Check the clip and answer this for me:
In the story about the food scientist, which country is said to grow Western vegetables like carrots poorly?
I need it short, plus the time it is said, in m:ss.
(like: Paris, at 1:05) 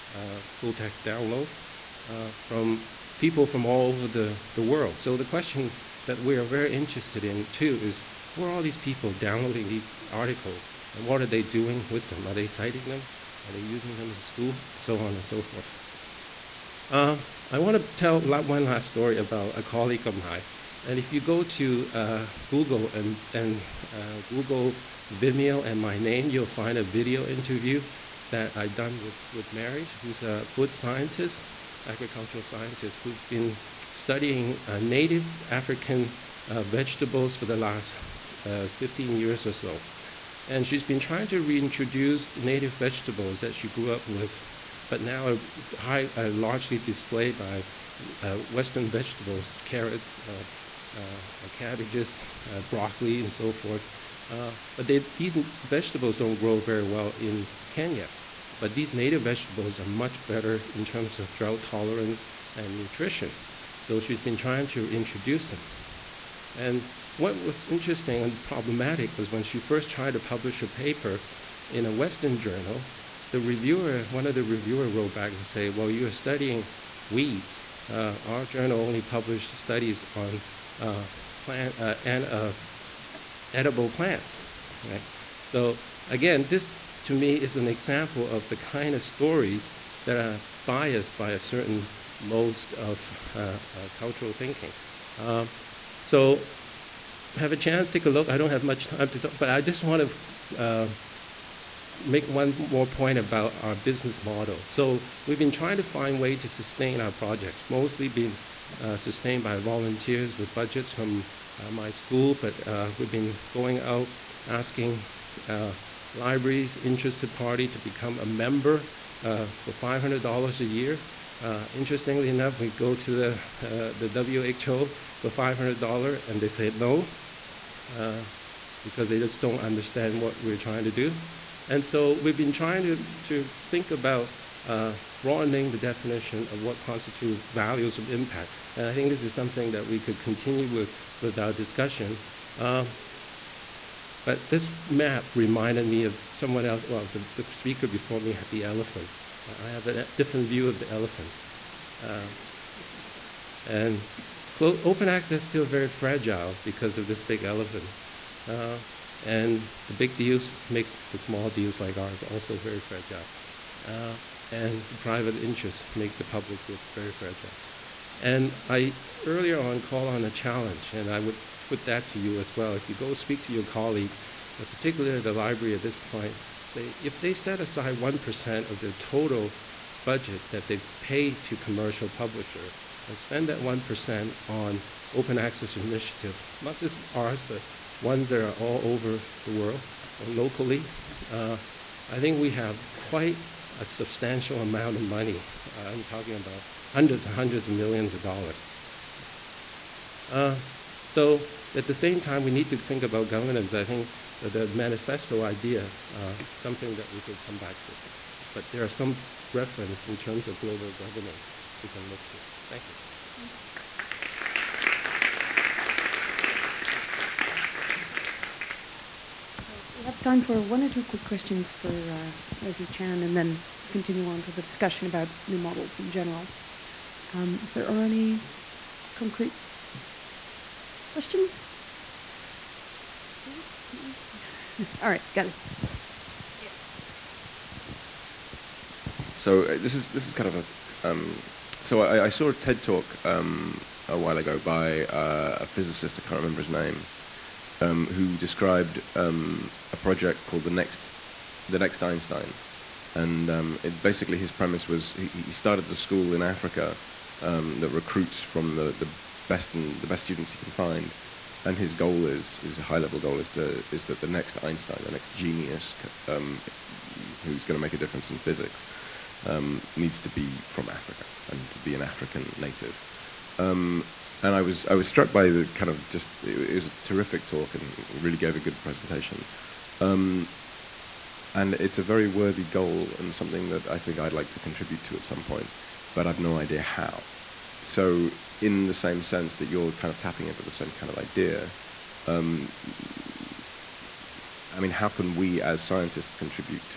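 Kenya, at 0:57.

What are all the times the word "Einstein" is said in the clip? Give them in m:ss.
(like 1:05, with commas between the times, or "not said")
4:12, 4:24.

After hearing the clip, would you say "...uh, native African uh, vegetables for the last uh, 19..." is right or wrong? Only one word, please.
wrong.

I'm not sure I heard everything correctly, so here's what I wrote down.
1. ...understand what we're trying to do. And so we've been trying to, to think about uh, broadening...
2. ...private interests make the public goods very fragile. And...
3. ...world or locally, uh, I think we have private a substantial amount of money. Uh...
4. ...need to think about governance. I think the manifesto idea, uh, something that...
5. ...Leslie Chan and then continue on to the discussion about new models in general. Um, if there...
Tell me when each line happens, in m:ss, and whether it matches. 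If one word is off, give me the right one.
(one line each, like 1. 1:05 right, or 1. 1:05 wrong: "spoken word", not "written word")
1. 2:09 right
2. 2:44 right
3. 3:09 wrong: "quite", not "private"
4. 3:22 right
5. 3:42 right.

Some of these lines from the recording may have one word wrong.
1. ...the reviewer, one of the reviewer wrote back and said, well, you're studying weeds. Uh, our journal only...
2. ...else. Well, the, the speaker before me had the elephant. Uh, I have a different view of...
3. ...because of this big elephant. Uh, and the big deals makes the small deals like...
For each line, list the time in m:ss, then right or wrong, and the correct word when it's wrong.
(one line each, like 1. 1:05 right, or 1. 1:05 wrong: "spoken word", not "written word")
1. 1:13 right
2. 2:26 right
3. 2:36 right.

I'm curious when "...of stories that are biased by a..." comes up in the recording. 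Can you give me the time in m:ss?
1:28.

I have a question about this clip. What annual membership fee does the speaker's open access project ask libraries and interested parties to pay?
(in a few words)
$500.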